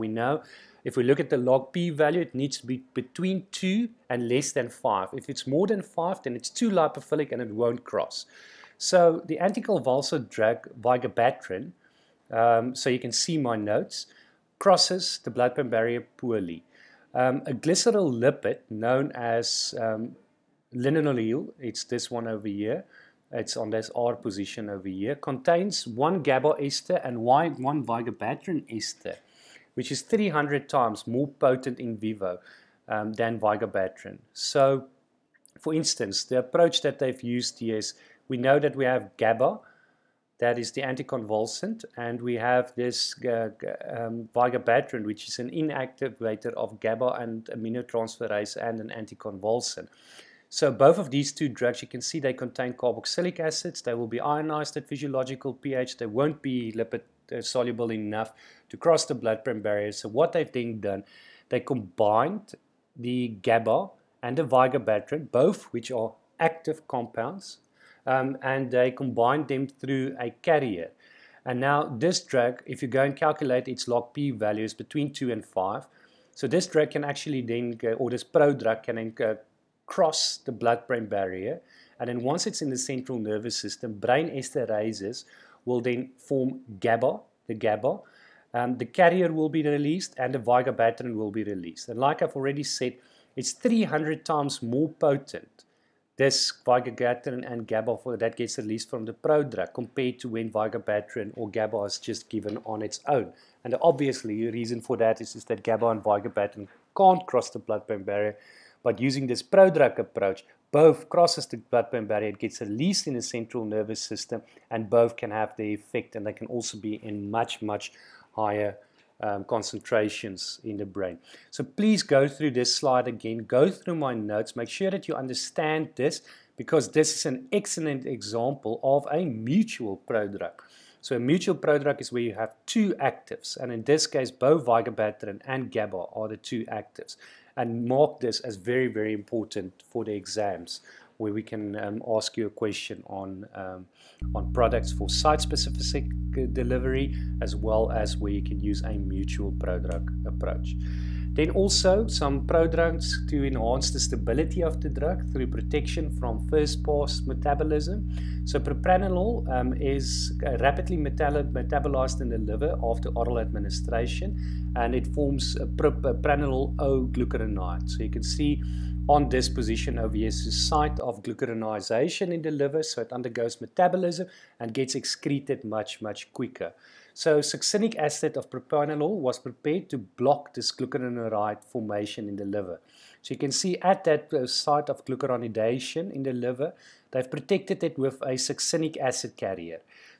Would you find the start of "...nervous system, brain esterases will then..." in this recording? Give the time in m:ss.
1:23.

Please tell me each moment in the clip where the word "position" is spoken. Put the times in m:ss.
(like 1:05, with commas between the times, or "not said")
0:24, 2:49.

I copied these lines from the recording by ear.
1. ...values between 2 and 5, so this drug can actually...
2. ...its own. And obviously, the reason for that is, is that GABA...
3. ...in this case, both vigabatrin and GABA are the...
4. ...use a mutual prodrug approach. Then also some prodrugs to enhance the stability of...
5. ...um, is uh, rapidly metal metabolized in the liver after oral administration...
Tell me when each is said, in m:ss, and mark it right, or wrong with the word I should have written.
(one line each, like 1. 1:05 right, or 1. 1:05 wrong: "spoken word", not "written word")
1. 1:14 right
2. 1:42 right
3. 2:13 right
4. 2:28 right
5. 2:39 right.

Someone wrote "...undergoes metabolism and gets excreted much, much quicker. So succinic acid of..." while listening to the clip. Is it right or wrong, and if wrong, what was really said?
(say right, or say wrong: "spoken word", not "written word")
right.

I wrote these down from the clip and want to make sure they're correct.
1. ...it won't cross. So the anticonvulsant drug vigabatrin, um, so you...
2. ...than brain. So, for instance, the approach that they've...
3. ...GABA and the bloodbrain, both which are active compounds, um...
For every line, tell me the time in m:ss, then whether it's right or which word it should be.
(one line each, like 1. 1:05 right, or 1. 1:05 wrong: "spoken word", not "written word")
1. 0:07 right
2. 0:33 wrong: "vigabatrin", not "brain"
3. 1:03 wrong: "vigabatrin", not "bloodbrain".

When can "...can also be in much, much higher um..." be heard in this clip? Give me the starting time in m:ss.
1:56.